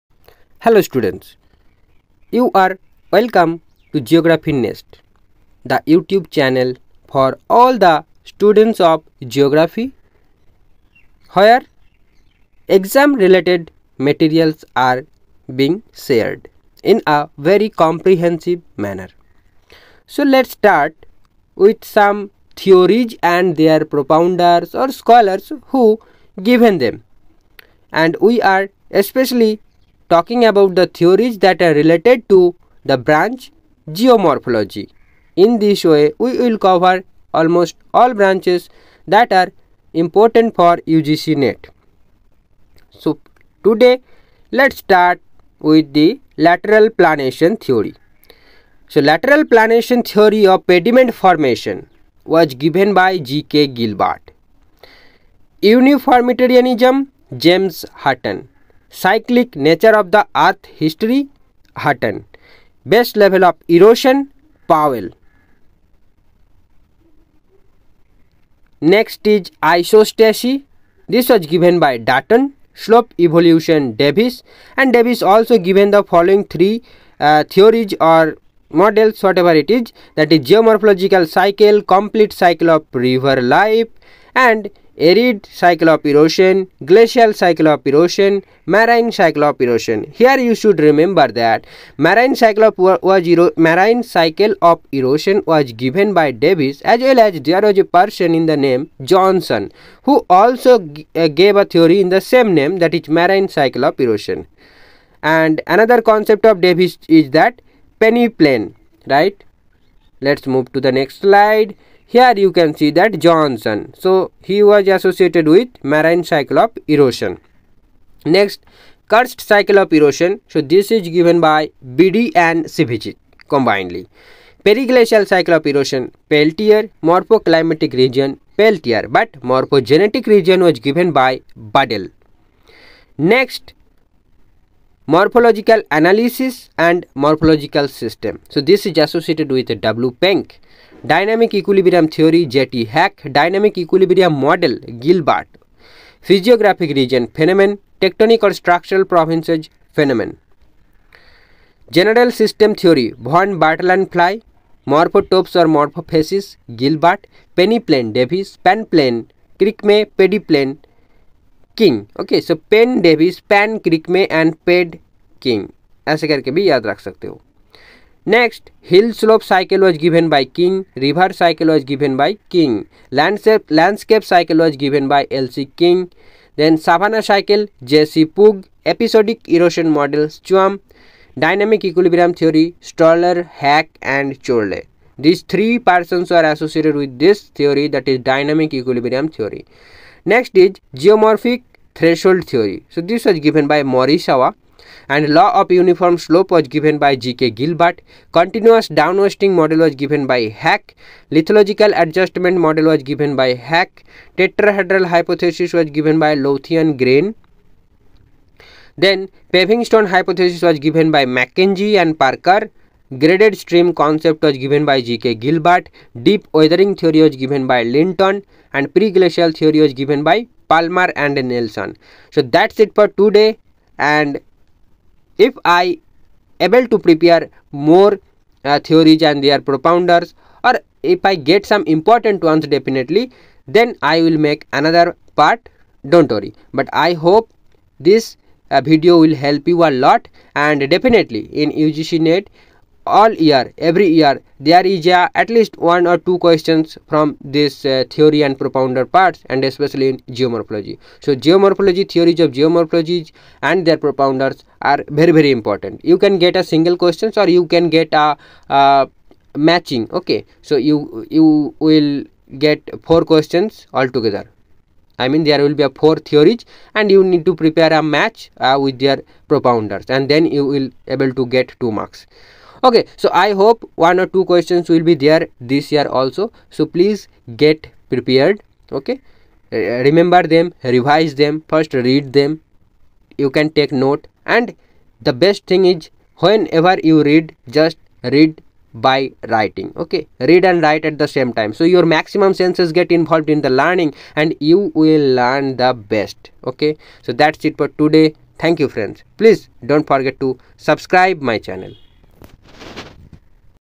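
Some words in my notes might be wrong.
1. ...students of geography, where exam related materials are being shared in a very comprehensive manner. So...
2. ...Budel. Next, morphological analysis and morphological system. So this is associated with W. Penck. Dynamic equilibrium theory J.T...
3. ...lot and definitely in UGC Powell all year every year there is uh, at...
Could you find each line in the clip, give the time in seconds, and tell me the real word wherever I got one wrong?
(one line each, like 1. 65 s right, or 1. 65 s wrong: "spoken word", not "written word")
1. 8 s right
2. 131 s right
3. 239 s wrong: "NET", not "Powell".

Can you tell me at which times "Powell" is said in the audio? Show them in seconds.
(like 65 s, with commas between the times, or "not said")
64 s.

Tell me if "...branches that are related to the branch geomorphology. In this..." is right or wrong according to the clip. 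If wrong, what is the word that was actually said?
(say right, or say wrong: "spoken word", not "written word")
wrong: "theories", not "branches".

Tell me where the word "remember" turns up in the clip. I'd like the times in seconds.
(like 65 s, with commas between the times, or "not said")
90 s, 280 s.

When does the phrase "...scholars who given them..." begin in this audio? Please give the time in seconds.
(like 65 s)
24 s.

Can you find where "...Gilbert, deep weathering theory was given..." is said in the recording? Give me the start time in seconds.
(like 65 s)
215 s.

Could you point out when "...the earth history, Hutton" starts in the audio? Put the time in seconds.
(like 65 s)
60 s.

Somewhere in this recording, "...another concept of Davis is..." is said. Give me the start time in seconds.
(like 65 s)
105 s.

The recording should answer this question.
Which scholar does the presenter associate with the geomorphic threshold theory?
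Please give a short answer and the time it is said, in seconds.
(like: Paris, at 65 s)
Morisawa, at 193 s.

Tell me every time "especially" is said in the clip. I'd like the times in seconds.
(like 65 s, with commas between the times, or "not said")
28 s, 249 s.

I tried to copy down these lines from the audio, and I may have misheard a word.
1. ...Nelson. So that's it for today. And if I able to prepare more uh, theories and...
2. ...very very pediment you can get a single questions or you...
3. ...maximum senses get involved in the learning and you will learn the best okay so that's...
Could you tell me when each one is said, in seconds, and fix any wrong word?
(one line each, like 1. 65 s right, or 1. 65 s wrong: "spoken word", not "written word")
1. 221 s right
2. 255 s wrong: "important", not "pediment"
3. 292 s right.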